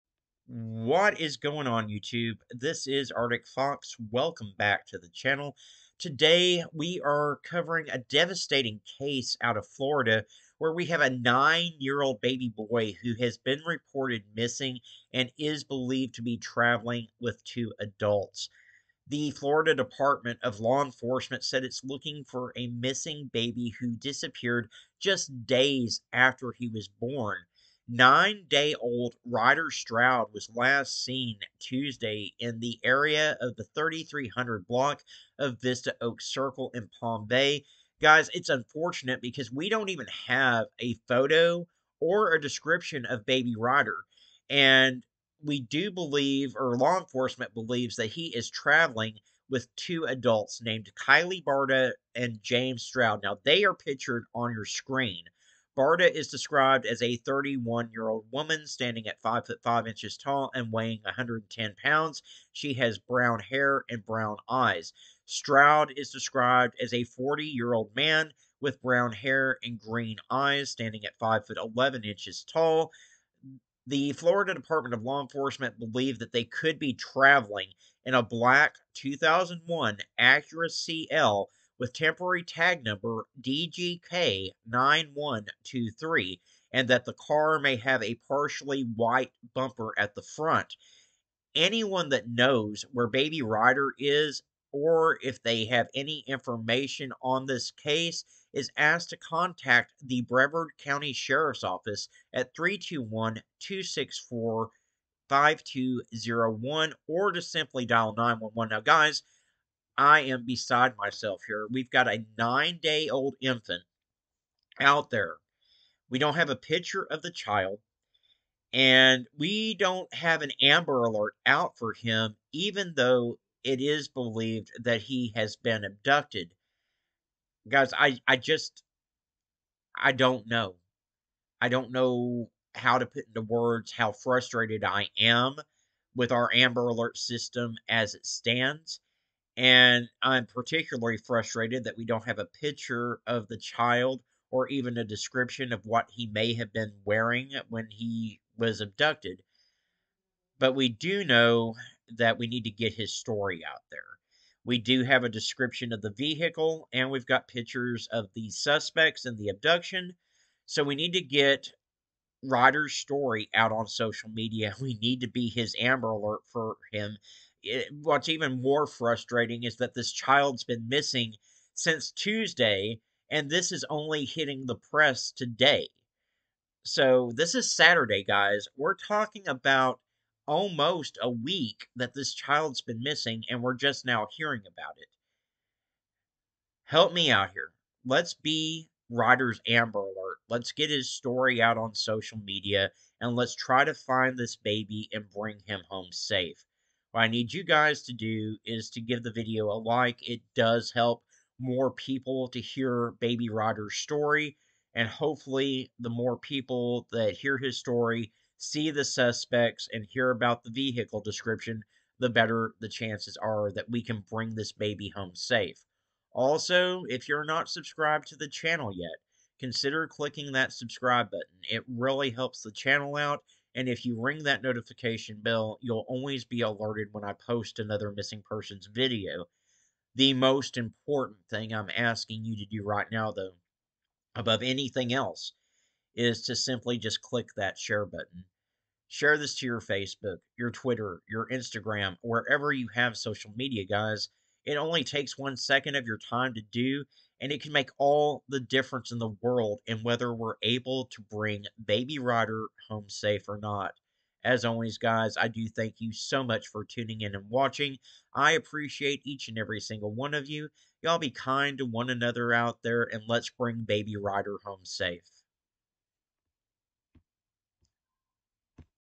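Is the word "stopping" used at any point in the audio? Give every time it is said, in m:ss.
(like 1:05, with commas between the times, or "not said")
not said.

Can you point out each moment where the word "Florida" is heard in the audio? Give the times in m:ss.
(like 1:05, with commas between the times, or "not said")
0:09, 0:19, 1:14.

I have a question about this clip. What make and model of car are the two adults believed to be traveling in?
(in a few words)
Acura CL.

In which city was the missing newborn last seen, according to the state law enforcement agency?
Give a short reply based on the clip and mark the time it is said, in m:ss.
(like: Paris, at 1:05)
Palm Bay, at 0:36.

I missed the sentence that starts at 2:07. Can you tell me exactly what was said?
Guys, I, I just, I don't know.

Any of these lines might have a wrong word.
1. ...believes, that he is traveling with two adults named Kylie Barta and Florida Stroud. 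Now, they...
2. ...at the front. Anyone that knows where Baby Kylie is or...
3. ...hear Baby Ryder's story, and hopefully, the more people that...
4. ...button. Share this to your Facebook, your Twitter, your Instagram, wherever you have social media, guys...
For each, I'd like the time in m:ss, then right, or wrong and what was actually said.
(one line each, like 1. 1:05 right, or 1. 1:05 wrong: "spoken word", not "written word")
1. 0:47 wrong: "James", not "Florida"
2. 1:29 wrong: "Ryder", not "Kylie"
3. 3:22 right
4. 3:58 right.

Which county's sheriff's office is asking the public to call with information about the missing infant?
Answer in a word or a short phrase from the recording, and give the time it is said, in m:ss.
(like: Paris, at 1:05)
Brevard County, at 1:40.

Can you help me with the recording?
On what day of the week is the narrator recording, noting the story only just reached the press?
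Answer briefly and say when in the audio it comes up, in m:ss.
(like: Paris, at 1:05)
Saturday, at 2:57.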